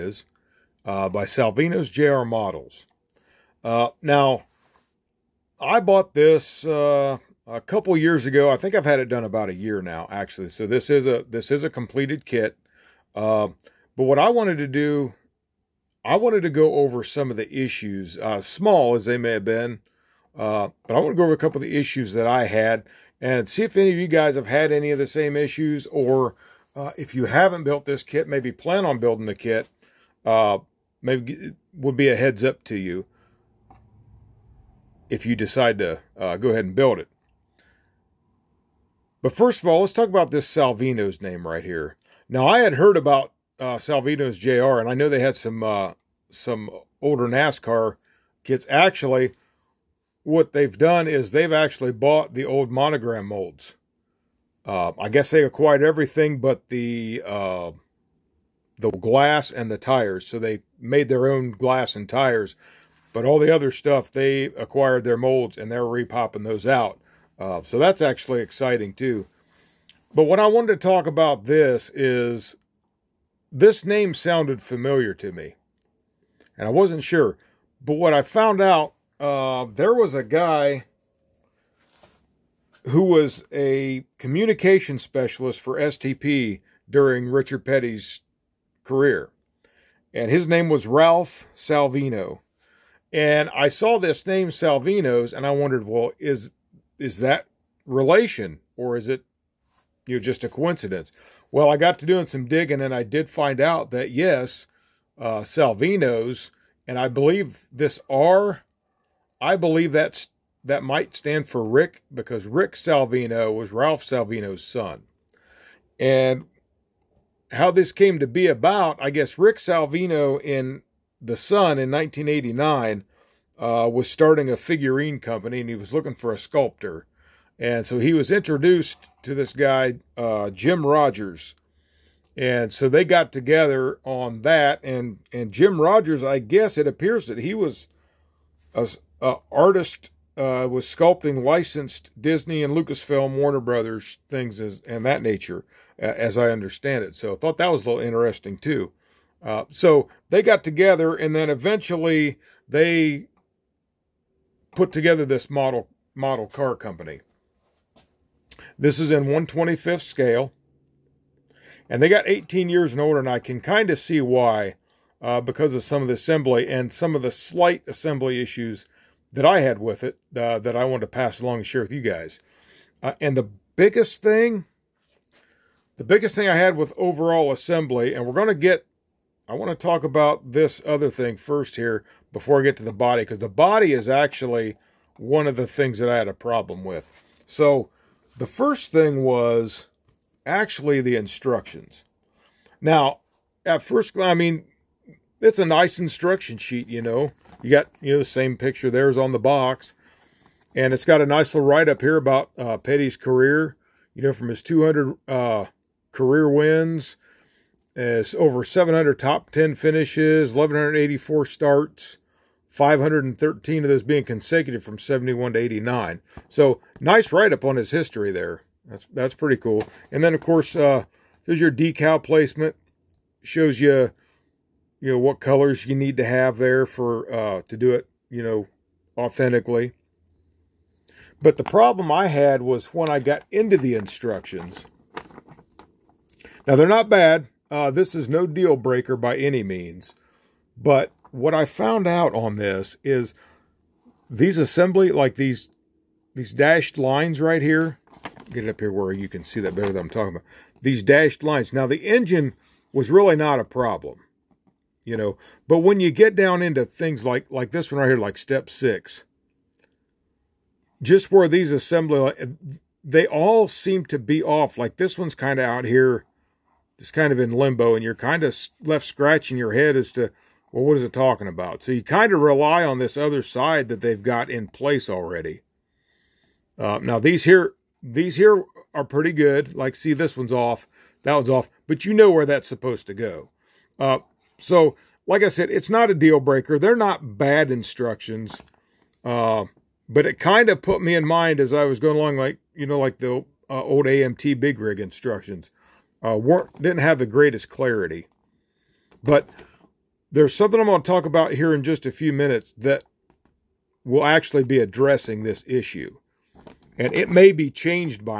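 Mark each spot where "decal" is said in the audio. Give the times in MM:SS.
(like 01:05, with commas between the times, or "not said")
03:41.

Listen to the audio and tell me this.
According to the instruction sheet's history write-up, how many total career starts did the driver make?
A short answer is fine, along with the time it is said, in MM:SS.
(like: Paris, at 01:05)
1,184, at 03:30.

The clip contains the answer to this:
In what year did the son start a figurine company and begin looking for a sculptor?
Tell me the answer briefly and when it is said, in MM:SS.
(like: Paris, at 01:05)
1989, at 02:01.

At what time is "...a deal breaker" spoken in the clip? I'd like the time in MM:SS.
04:46.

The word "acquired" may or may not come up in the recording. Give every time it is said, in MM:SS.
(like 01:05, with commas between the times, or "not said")
00:55, 01:04.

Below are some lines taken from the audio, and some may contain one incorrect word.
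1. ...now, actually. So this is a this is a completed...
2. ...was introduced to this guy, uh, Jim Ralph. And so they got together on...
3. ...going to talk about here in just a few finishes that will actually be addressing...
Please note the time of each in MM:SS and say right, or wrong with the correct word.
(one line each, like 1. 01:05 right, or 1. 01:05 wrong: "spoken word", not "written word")
1. 00:09 right
2. 02:08 wrong: "Rogers", not "Ralph"
3. 05:00 wrong: "minutes", not "finishes".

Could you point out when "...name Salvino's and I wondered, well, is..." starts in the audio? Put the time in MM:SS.
01:34.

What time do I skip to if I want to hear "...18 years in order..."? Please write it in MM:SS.
02:42.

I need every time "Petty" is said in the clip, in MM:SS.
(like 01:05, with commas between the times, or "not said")
01:27, 03:22.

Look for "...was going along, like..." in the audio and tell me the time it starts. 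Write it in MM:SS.
04:51.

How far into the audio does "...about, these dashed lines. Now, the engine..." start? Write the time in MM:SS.
04:10.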